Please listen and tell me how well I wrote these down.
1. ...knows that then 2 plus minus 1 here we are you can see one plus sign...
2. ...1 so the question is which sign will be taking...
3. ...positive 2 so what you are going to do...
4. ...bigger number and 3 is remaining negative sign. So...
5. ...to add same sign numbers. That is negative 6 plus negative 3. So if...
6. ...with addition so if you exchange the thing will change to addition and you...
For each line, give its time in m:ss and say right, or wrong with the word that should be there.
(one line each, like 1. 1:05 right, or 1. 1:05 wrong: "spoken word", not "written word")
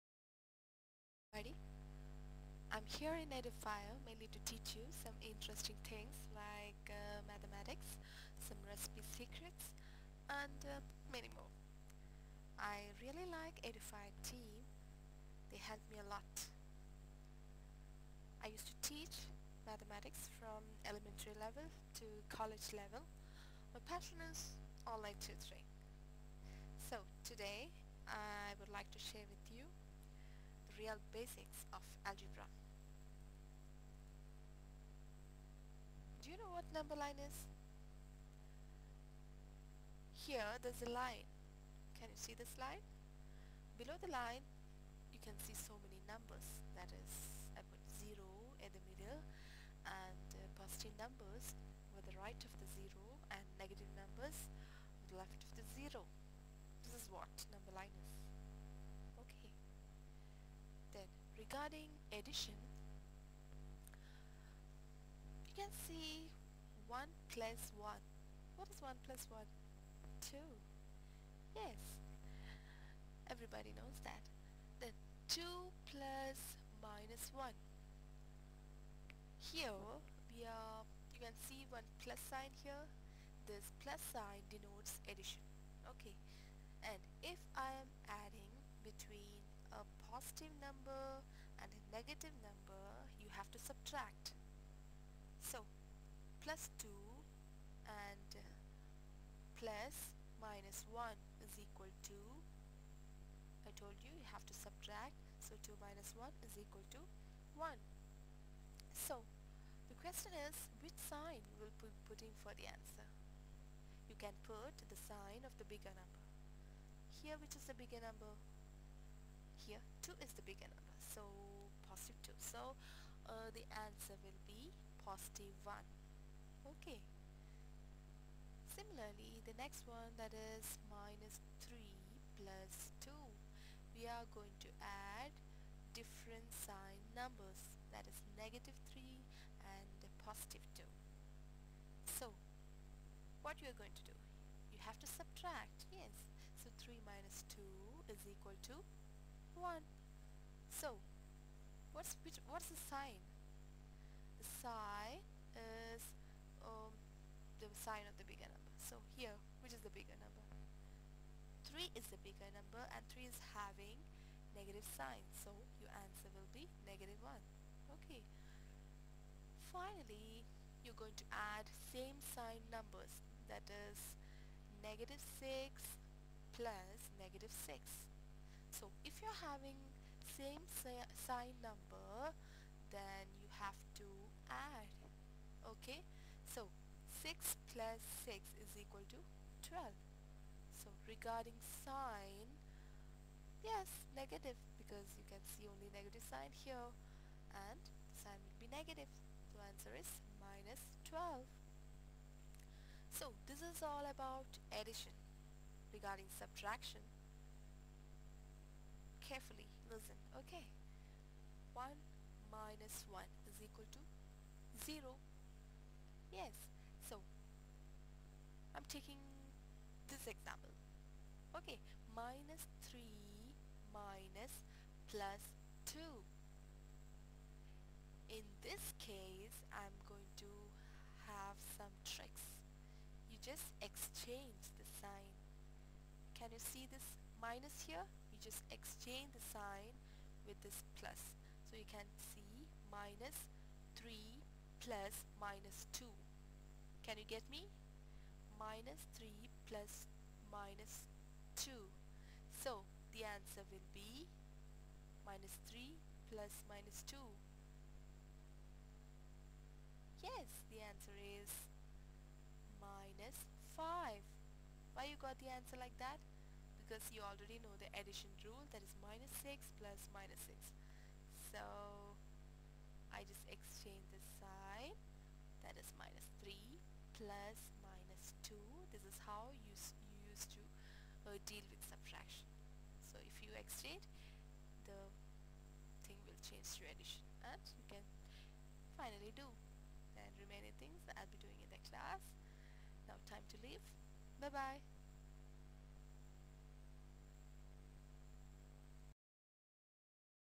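1. 1:13 right
2. 1:47 wrong: "putting", not "taking"
3. 2:20 right
4. 2:42 wrong: "having", not "remaining"
5. 2:51 wrong: "6", not "3"
6. 4:41 wrong: "subtraction", not "addition".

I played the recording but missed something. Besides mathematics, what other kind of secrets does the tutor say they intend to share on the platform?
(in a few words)
recipe secrets.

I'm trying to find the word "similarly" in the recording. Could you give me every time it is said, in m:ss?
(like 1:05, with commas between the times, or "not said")
2:08.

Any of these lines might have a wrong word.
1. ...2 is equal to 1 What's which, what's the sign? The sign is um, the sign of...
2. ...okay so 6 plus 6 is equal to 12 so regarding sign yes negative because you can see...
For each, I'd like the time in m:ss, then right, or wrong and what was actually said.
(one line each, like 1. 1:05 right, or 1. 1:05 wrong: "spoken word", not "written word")
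1. 2:27 right
2. 3:05 right.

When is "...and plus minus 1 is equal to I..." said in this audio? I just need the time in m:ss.
1:37.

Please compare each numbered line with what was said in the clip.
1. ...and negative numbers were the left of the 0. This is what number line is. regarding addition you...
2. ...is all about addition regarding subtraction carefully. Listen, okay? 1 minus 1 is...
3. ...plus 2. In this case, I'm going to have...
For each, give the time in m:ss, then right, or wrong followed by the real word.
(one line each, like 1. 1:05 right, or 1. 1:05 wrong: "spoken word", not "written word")
1. 0:53 right
2. 3:23 right
3. 3:45 right.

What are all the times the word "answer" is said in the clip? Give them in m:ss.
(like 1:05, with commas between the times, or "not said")
1:52, 2:03, 2:45, 3:19, 4:13, 4:20, 4:25.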